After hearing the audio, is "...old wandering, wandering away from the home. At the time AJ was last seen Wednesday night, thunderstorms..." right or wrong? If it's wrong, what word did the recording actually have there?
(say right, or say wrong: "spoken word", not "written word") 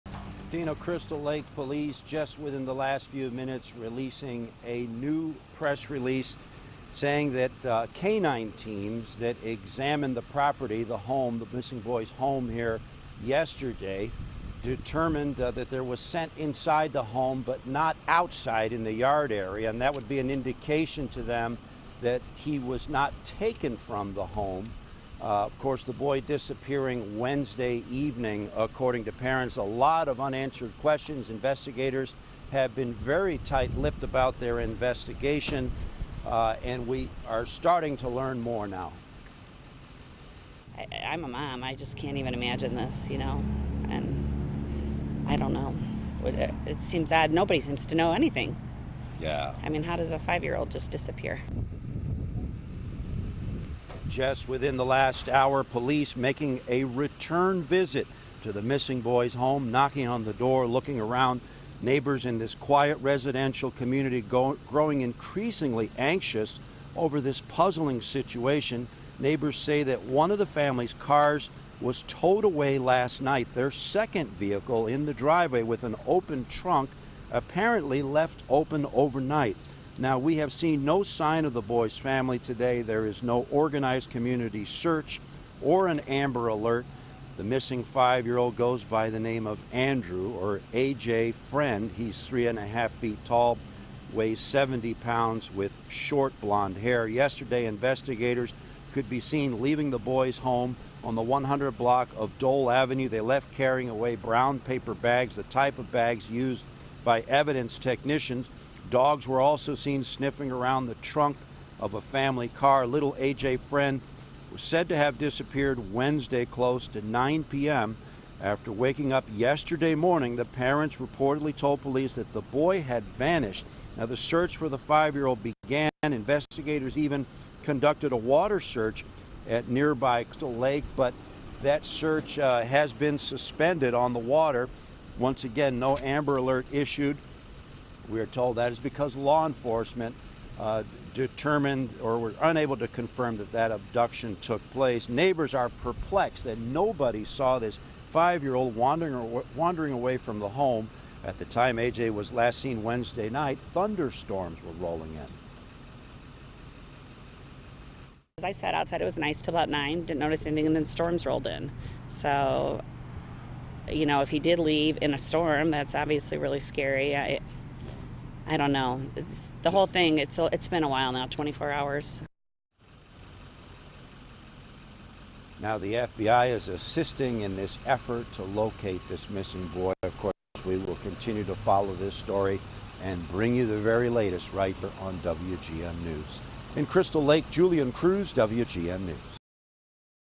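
right.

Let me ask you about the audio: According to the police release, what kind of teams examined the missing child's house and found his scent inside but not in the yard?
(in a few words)
Canine teams.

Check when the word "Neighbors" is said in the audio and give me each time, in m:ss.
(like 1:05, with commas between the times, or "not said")
1:01, 1:09, 2:25.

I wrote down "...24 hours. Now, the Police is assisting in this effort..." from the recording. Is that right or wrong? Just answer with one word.
wrong.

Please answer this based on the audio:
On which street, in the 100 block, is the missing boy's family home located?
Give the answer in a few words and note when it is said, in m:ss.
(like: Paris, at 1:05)
Dole Avenue, at 1:42.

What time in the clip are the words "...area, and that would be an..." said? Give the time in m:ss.
0:19.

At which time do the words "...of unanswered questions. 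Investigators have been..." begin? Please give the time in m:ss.
0:30.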